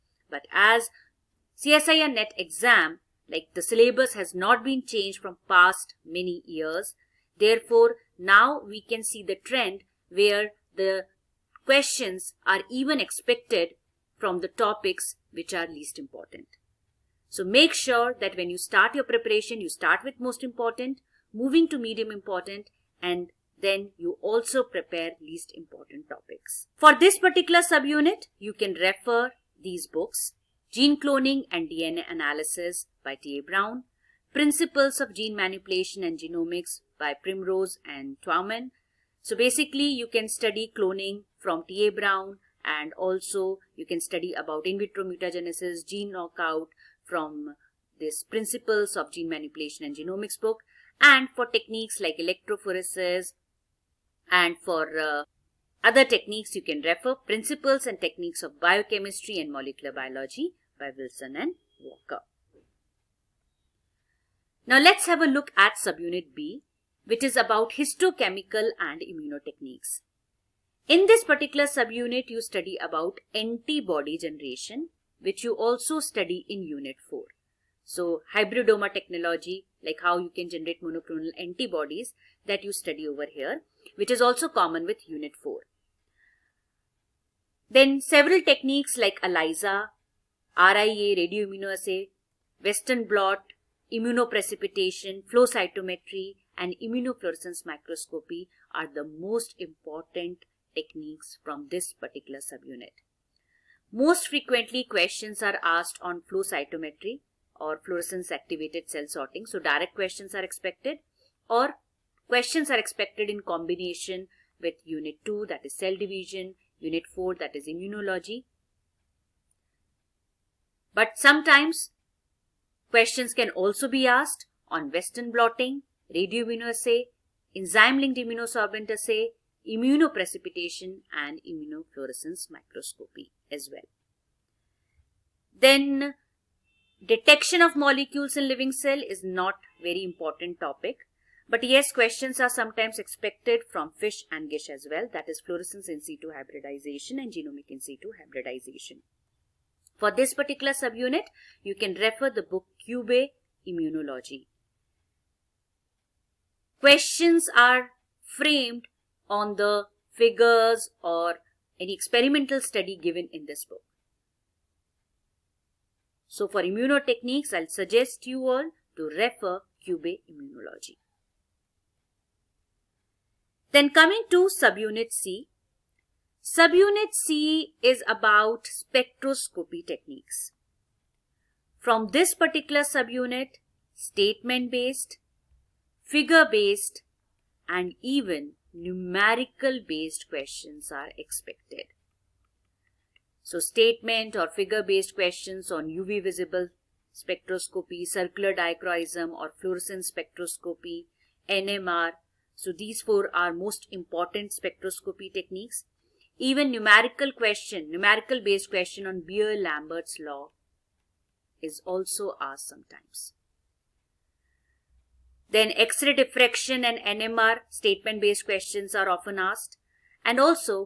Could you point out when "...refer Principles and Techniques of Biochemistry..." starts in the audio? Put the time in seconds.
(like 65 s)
56 s.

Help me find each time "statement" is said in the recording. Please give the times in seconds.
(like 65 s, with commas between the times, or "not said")
183 s, 193 s, 217 s.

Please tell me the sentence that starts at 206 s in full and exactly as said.
Even numerical question, numerical based question on Beer-Lambert's law is also asked sometimes.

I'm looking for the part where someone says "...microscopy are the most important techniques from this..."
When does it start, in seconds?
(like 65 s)
97 s.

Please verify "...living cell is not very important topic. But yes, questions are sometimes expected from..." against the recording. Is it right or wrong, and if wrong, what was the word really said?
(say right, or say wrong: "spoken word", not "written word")
right.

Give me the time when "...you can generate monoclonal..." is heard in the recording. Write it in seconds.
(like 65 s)
80 s.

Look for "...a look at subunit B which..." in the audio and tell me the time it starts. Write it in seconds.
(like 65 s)
65 s.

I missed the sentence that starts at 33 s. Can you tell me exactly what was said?
Brown, Principles of Gene Manipulation and Genomics by Primrose and Twyman.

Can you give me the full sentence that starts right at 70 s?
In this particular subunit you study about antibody generation which you also study in Unit 4.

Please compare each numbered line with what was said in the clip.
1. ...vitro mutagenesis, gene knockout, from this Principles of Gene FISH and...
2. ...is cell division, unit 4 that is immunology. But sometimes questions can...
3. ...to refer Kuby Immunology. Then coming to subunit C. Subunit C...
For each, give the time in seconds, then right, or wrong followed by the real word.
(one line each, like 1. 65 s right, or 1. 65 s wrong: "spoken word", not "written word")
1. 44 s wrong: "Manipulation", not "FISH"
2. 115 s right
3. 168 s right.